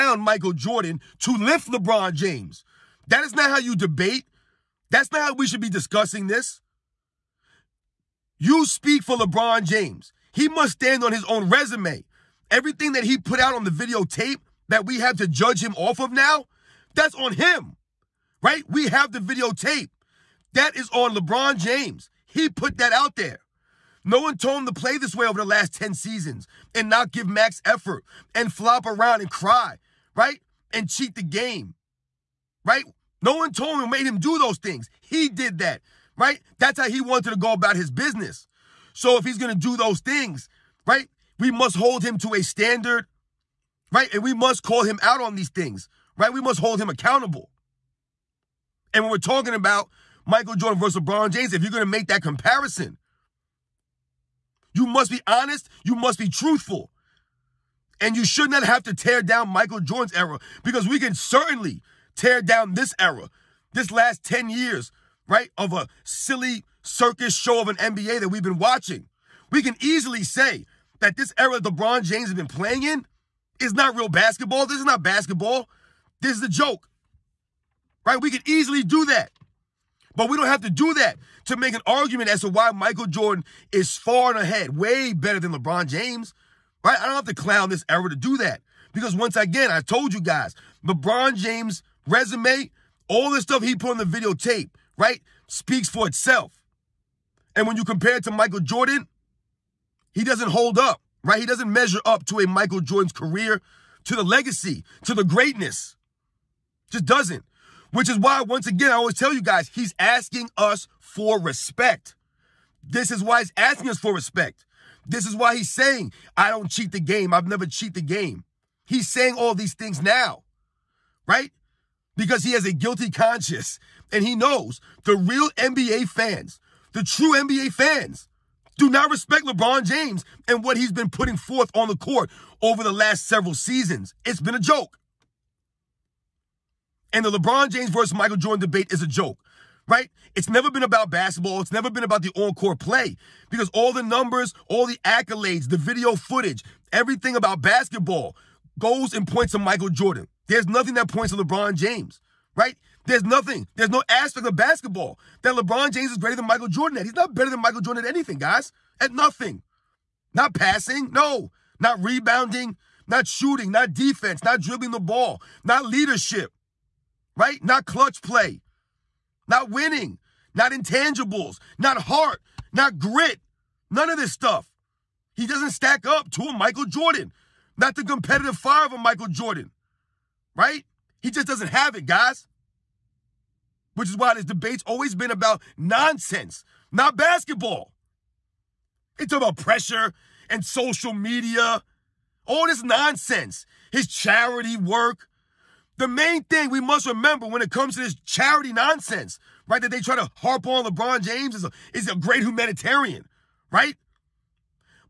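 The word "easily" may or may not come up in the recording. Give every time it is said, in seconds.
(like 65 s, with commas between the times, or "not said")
69 s, 78 s.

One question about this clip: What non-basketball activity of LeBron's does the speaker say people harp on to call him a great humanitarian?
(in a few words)
charity work.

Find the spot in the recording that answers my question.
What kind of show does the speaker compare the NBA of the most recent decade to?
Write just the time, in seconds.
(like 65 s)
66 s.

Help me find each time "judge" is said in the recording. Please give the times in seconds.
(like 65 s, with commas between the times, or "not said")
15 s.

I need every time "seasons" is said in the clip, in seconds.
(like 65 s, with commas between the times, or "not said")
25 s, 133 s.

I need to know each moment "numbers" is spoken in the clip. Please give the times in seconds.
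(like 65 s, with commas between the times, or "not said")
144 s.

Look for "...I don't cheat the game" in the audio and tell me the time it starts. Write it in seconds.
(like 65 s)
116 s.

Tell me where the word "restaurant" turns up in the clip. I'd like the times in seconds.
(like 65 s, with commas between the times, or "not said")
not said.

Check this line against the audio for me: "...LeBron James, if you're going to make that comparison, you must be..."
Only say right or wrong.
right.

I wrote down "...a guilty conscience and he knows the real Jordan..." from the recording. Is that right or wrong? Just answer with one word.
wrong.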